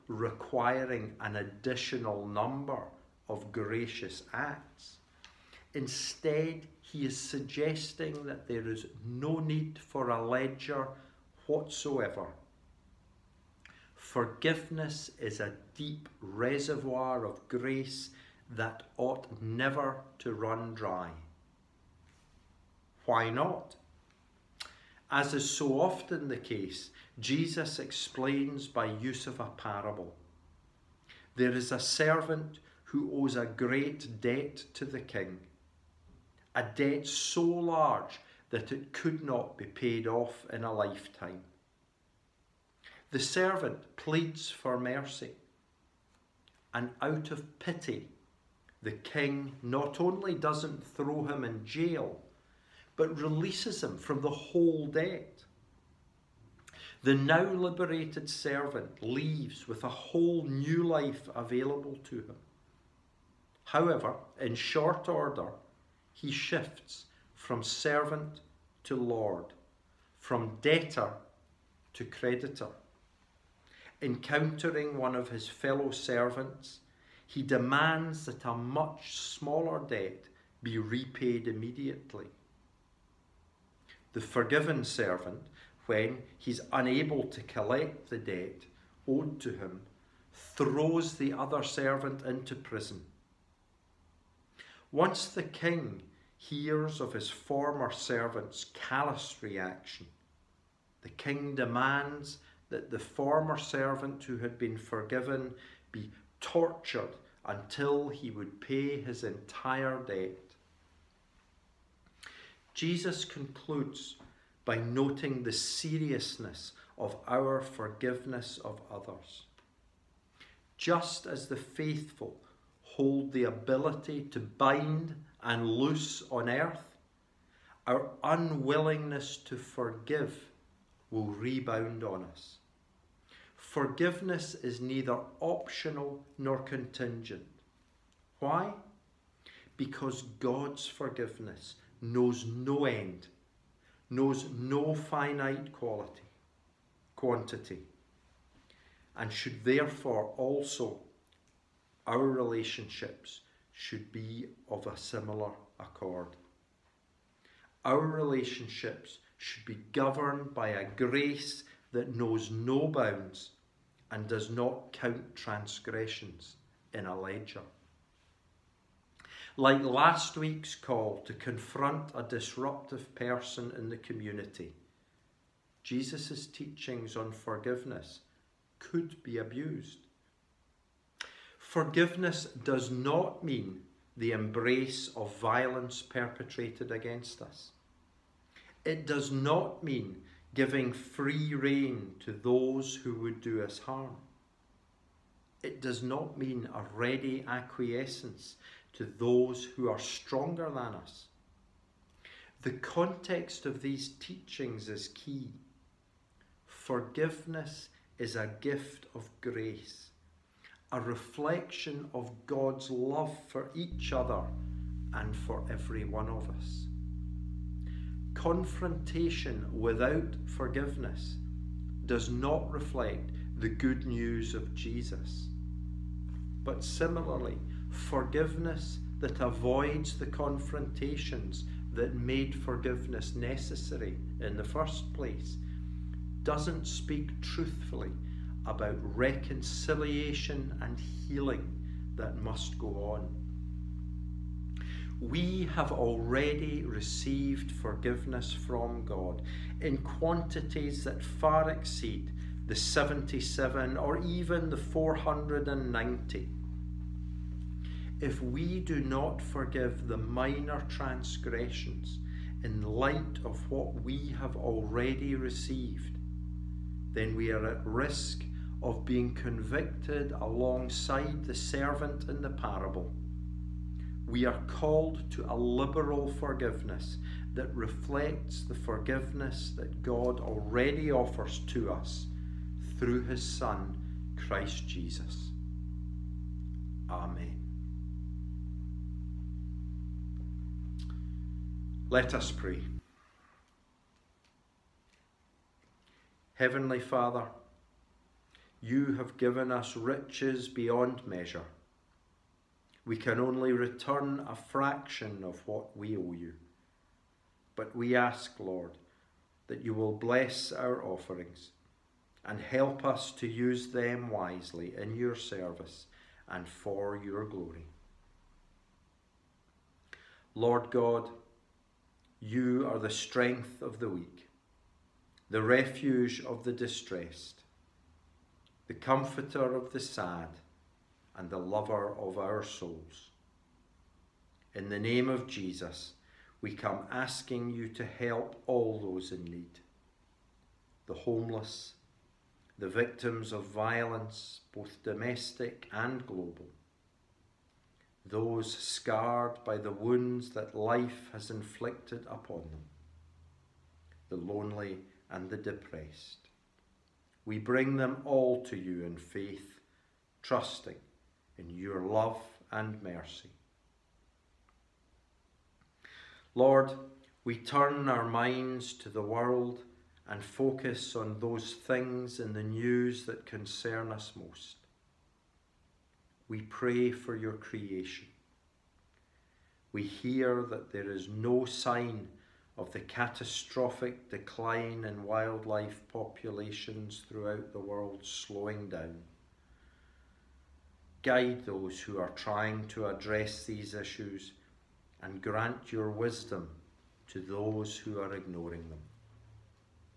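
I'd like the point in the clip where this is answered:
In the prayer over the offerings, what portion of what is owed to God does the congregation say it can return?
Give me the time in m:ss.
5:04.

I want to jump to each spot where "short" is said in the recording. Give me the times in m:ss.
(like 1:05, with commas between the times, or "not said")
1:04.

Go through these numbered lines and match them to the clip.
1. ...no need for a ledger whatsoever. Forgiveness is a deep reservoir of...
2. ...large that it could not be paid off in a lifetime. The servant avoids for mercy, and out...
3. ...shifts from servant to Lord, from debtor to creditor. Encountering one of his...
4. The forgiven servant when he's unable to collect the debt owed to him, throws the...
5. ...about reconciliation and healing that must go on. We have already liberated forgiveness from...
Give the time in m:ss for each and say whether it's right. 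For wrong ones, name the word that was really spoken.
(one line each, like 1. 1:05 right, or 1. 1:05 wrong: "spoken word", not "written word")
1. 0:09 right
2. 0:37 wrong: "pleads", not "avoids"
3. 1:06 right
4. 1:24 right
5. 3:58 wrong: "received", not "liberated".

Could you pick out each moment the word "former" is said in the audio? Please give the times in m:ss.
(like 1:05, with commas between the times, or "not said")
1:37, 1:42.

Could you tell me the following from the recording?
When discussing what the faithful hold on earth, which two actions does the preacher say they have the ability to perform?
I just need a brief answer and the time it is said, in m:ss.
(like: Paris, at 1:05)
Bind and loose, at 2:04.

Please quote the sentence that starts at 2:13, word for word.
Forgiveness is neither optional nor contingent.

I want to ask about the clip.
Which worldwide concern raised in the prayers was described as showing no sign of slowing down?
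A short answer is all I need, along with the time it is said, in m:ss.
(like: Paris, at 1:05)
Decline in wildlife populations, at 6:24.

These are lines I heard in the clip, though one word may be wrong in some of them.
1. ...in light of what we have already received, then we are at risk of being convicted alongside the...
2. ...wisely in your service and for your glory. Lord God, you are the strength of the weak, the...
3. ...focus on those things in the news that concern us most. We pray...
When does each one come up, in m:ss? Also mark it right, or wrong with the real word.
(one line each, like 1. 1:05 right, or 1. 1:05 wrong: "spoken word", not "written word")
1. 4:22 right
2. 5:14 right
3. 6:10 right.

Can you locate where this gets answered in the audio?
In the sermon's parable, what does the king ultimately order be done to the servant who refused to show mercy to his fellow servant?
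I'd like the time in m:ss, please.
1:46.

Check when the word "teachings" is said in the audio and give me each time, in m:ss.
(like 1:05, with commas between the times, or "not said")
2:56, 3:24.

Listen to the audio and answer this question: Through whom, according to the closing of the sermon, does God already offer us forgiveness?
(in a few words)
Christ Jesus.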